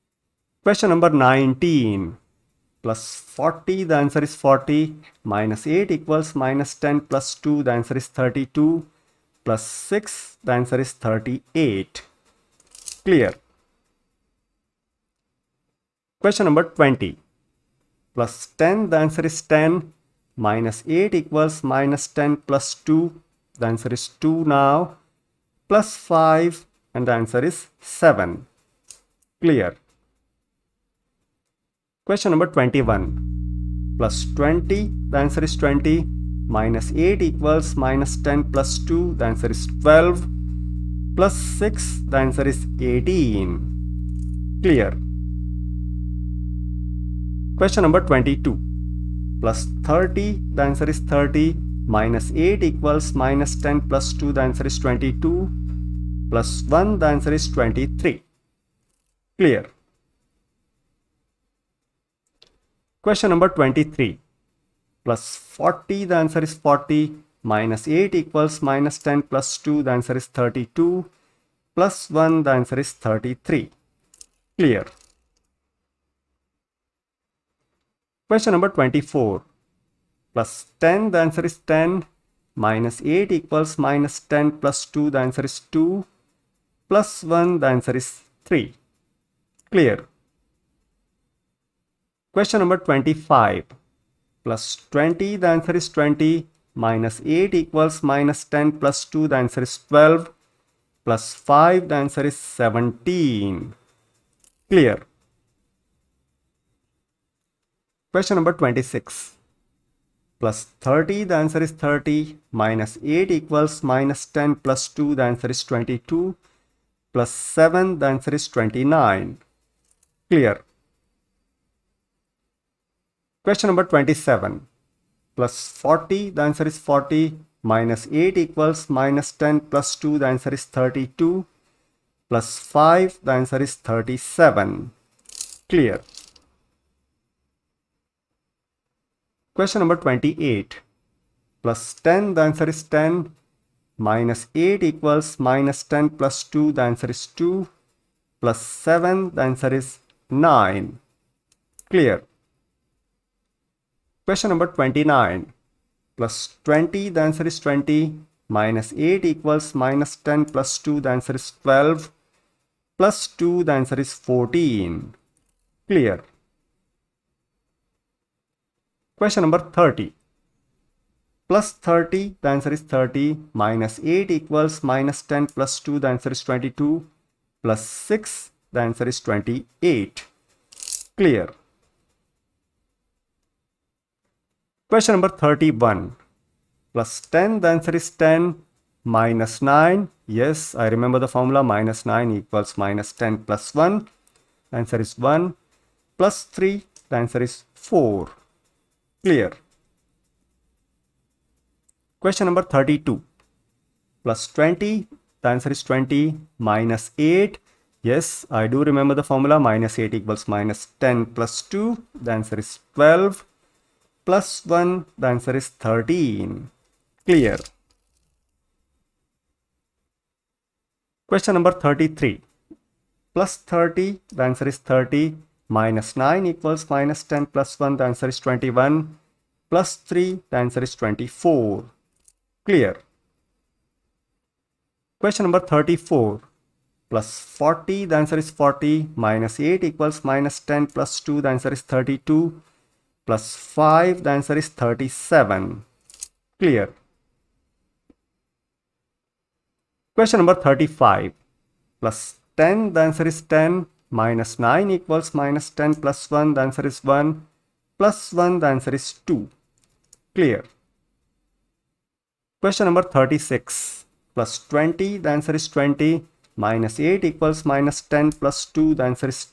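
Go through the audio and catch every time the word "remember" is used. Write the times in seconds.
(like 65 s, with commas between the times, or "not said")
190 s, 208 s.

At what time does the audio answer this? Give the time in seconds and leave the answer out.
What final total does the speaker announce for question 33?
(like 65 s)
230 s.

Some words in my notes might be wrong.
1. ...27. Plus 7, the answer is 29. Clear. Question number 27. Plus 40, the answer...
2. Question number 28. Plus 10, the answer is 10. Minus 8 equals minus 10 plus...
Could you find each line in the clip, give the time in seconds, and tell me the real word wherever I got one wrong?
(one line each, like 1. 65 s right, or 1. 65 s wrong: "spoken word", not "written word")
1. 115 s wrong: "22", not "27"
2. 139 s right.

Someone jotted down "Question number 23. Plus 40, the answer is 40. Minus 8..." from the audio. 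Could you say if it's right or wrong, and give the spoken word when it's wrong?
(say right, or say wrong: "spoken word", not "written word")
right.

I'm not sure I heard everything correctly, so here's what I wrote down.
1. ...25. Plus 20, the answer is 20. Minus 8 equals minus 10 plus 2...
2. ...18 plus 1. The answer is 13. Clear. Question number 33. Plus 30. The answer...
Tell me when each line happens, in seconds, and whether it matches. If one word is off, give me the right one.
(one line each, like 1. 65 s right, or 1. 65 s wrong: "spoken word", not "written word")
1. 92 s right
2. 212 s wrong: "12", not "18".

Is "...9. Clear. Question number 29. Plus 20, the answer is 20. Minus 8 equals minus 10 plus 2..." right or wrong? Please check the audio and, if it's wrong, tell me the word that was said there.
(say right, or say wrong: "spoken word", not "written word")
right.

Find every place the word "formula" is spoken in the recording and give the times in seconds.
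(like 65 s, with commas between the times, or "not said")
191 s, 209 s.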